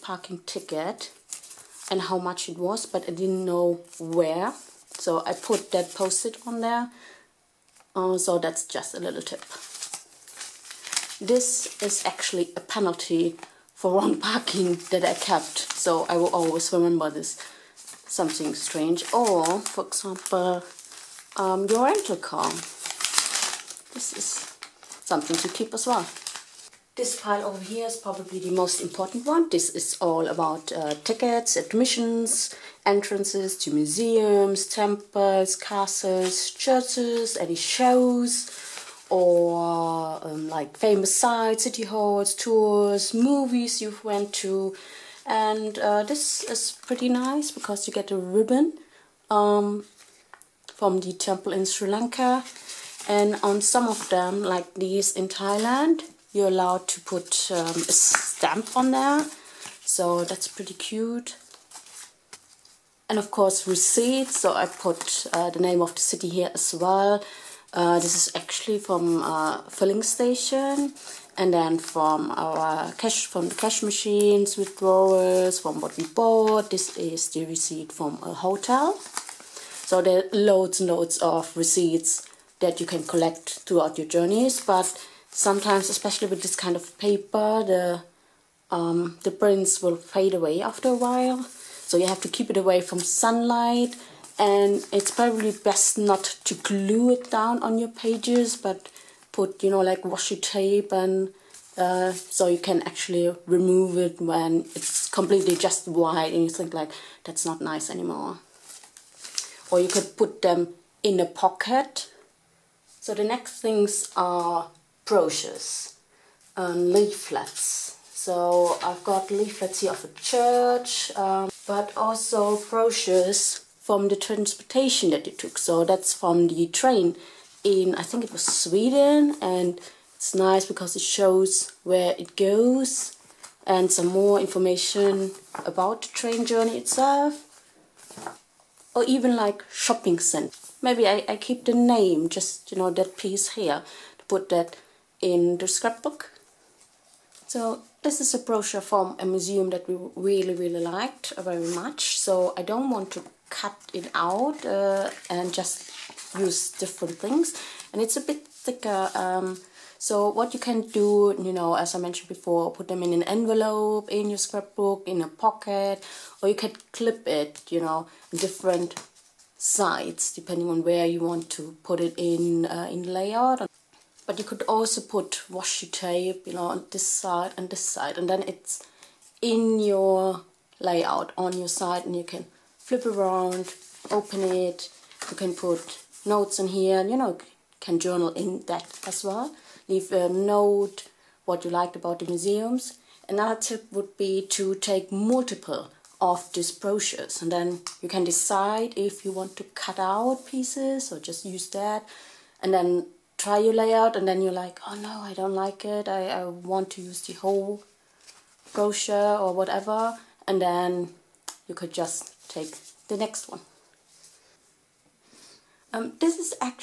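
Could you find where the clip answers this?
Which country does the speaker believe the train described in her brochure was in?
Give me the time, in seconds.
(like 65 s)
128 s.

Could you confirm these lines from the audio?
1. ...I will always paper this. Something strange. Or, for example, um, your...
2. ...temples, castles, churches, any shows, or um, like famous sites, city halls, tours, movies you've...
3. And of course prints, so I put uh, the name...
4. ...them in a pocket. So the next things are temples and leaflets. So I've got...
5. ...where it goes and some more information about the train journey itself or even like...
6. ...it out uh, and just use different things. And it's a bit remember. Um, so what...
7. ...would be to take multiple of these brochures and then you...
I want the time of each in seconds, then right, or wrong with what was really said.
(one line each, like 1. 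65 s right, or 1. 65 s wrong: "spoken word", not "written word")
1. 16 s wrong: "remember", not "paper"
2. 34 s right
3. 63 s wrong: "receipts", not "prints"
4. 110 s wrong: "brochures", not "temples"
5. 131 s right
6. 153 s wrong: "thicker", not "remember"
7. 193 s right.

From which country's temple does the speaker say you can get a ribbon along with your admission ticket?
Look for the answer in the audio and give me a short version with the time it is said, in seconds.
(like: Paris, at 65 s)
Sri Lanka, at 51 s.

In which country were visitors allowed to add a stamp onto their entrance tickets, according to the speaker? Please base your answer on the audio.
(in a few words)
Thailand.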